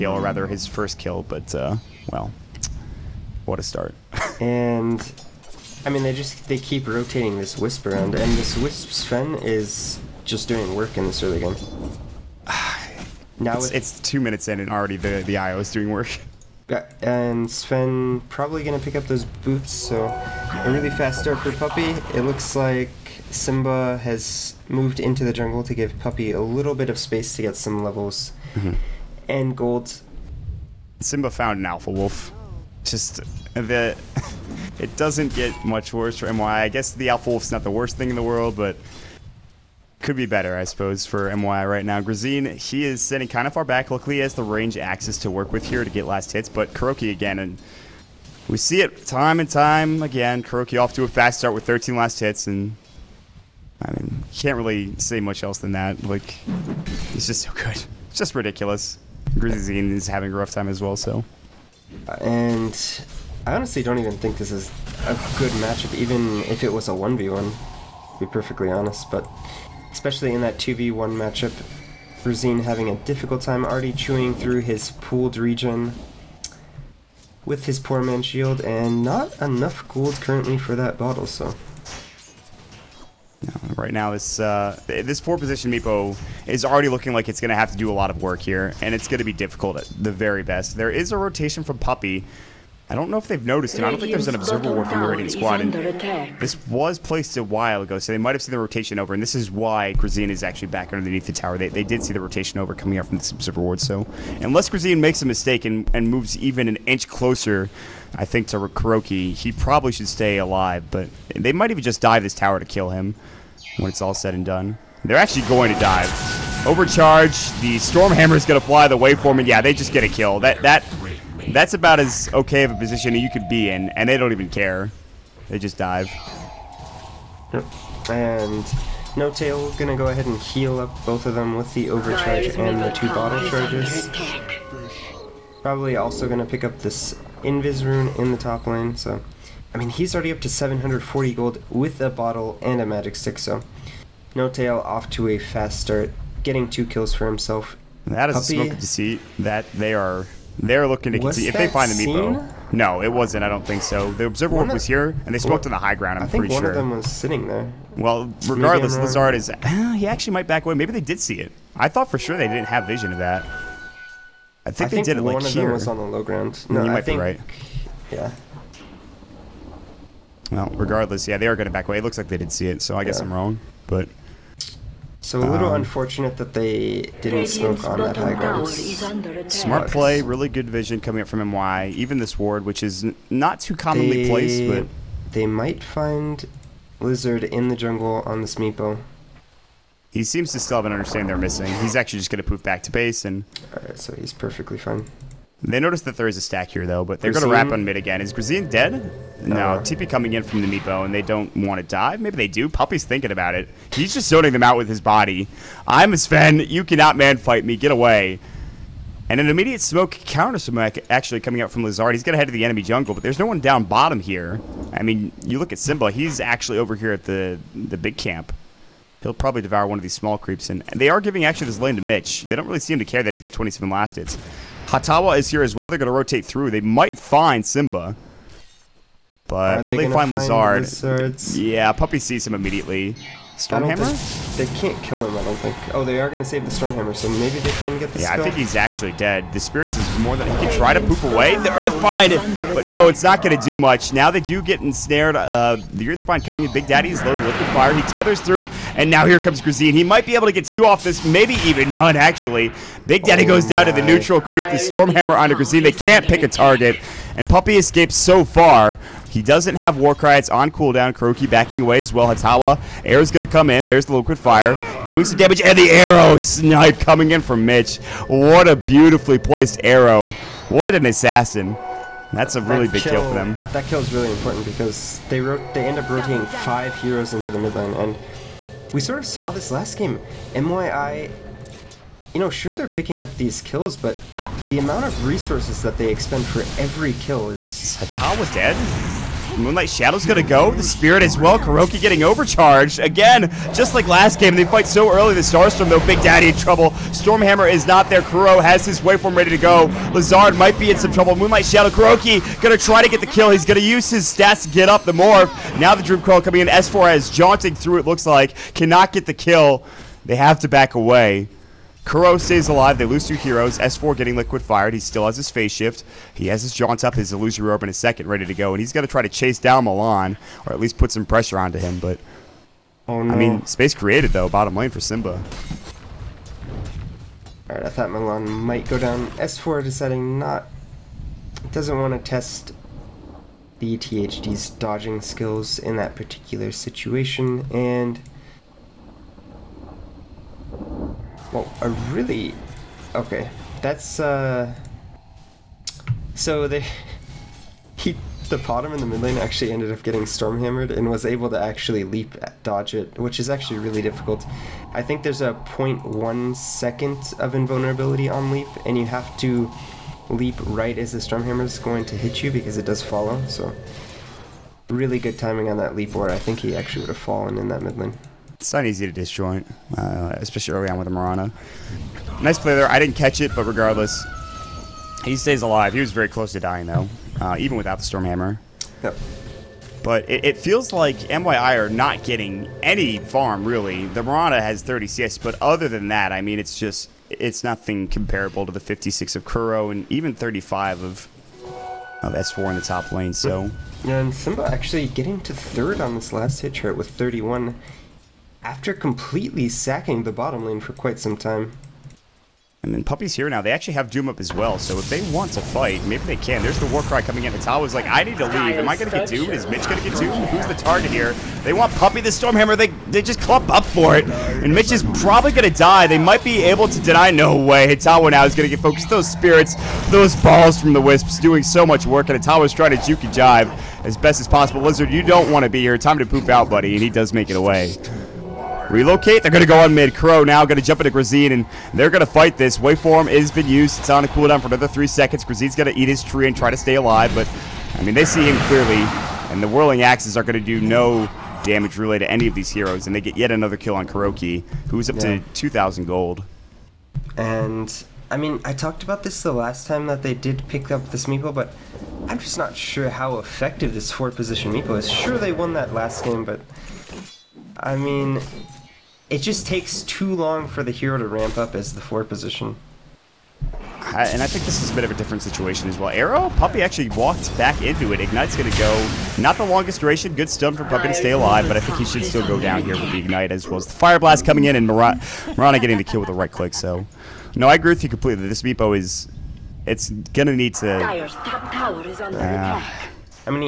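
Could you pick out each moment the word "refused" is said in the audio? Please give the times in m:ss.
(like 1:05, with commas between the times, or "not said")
not said.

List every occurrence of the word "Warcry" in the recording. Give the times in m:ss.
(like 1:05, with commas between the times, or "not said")
4:19, 6:46.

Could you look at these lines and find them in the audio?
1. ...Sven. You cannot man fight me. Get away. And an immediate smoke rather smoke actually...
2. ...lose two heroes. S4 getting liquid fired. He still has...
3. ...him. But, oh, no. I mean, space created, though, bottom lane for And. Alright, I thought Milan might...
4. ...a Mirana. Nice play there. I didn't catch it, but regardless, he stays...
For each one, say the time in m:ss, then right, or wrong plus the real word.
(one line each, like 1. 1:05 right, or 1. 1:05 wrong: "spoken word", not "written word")
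1. 3:26 wrong: "counter", not "rather"
2. 5:13 right
3. 5:21 wrong: "Simba", not "And"
4. 6:11 right.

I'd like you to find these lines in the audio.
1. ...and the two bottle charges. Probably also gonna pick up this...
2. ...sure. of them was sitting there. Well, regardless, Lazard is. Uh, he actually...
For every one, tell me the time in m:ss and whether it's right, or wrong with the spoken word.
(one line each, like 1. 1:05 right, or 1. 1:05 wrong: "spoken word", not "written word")
1. 2:12 right
2. 2:36 right.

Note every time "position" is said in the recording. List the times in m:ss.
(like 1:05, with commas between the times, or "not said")
1:25, 2:02, 7:34, 7:42.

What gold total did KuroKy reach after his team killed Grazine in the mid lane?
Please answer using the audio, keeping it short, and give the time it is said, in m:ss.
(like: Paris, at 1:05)
2,000, at 7:25.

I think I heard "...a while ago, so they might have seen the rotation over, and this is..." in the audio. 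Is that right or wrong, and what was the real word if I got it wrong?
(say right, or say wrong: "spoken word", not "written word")
right.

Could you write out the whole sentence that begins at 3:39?
He'll probably devour one of these small creeps.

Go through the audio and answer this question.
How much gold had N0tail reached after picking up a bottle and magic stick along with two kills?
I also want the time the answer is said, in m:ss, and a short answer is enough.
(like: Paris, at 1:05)
740, at 2:20.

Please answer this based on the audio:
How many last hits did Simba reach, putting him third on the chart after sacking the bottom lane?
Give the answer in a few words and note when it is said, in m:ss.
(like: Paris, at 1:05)
31, at 6:37.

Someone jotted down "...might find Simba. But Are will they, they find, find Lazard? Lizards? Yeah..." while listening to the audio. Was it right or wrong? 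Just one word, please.
right.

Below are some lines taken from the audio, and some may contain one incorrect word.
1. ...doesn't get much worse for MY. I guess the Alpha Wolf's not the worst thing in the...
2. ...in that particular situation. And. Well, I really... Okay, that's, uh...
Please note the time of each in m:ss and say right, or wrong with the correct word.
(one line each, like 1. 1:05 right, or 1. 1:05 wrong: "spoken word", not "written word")
1. 0:34 right
2. 5:35 right.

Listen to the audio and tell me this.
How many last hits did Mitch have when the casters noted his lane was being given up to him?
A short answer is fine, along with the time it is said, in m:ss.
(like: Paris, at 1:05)
27, at 3:43.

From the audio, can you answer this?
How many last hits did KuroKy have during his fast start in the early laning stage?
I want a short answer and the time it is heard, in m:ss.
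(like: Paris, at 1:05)
13, at 0:51.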